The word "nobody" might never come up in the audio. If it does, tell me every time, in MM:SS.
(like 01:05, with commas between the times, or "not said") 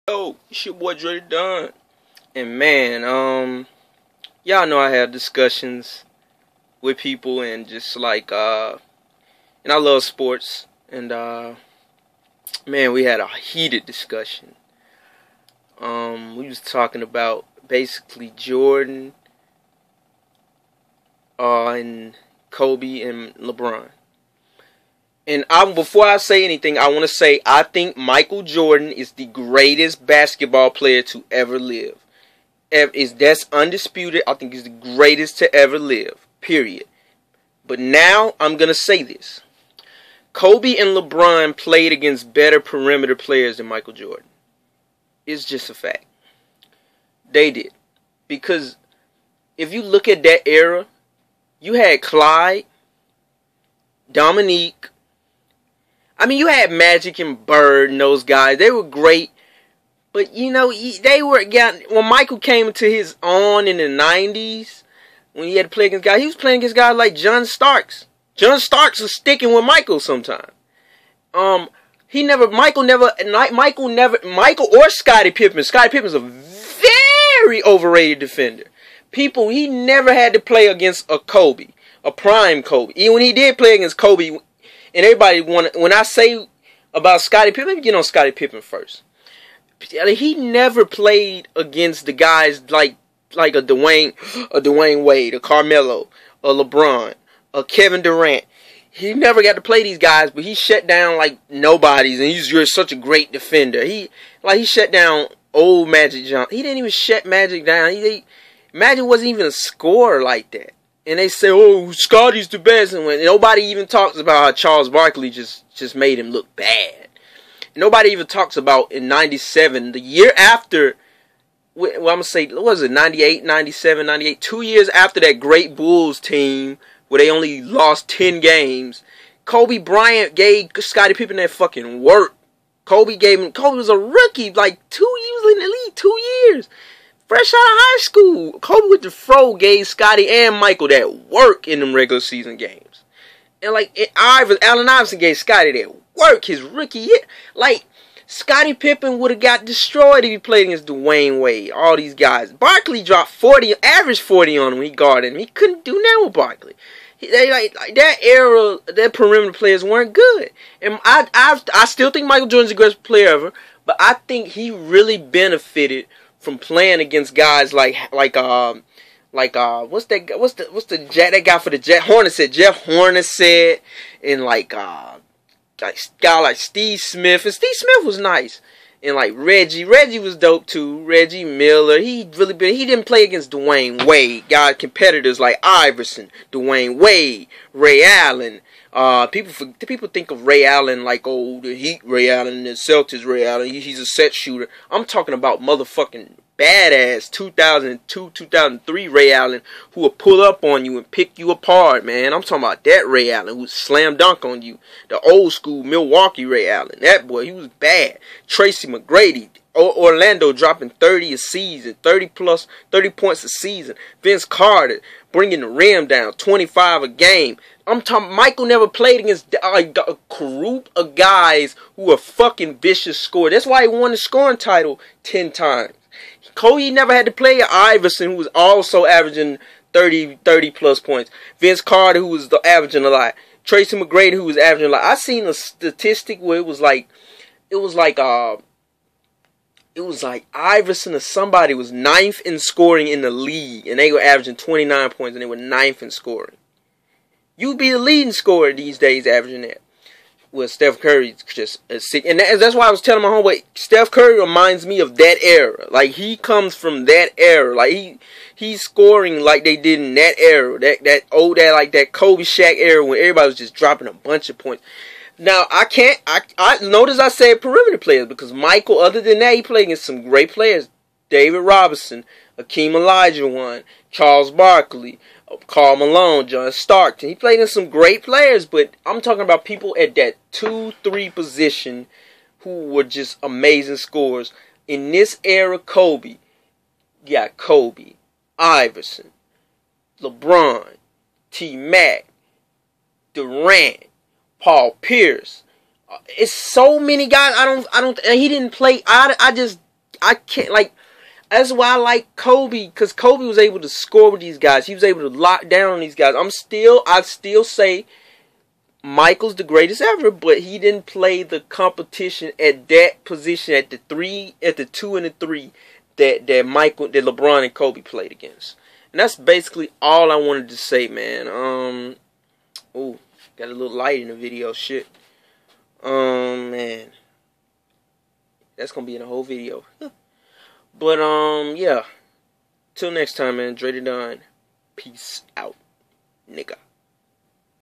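01:41, 01:53, 01:57.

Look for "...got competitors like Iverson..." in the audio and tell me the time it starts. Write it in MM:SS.
03:04.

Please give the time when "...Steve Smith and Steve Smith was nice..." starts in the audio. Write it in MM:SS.
02:56.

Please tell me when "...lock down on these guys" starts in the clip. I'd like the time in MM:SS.
05:05.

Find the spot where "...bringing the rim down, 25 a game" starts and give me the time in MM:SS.
03:35.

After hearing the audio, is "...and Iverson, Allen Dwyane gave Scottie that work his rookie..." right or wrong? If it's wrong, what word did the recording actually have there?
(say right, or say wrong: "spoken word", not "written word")
wrong: "Iverson", not "Dwyane".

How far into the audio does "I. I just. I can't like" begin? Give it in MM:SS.
04:59.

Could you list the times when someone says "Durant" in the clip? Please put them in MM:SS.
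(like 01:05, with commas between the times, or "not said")
01:38, 04:53.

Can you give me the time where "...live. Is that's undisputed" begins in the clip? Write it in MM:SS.
00:31.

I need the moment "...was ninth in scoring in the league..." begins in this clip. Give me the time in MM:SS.
04:01.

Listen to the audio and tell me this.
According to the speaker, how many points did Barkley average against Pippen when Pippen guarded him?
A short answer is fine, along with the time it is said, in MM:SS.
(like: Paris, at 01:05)
40, at 02:33.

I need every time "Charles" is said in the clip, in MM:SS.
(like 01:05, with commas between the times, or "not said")
01:54, 04:34.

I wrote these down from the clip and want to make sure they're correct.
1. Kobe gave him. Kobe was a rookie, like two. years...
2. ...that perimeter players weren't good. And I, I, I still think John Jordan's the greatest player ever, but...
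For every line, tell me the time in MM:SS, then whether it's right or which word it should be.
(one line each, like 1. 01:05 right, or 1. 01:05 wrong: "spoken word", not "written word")
1. 02:12 right
2. 02:38 wrong: "Michael", not "John".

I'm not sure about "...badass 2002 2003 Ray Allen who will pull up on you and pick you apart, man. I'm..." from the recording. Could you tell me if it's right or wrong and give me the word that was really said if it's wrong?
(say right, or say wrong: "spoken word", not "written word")
right.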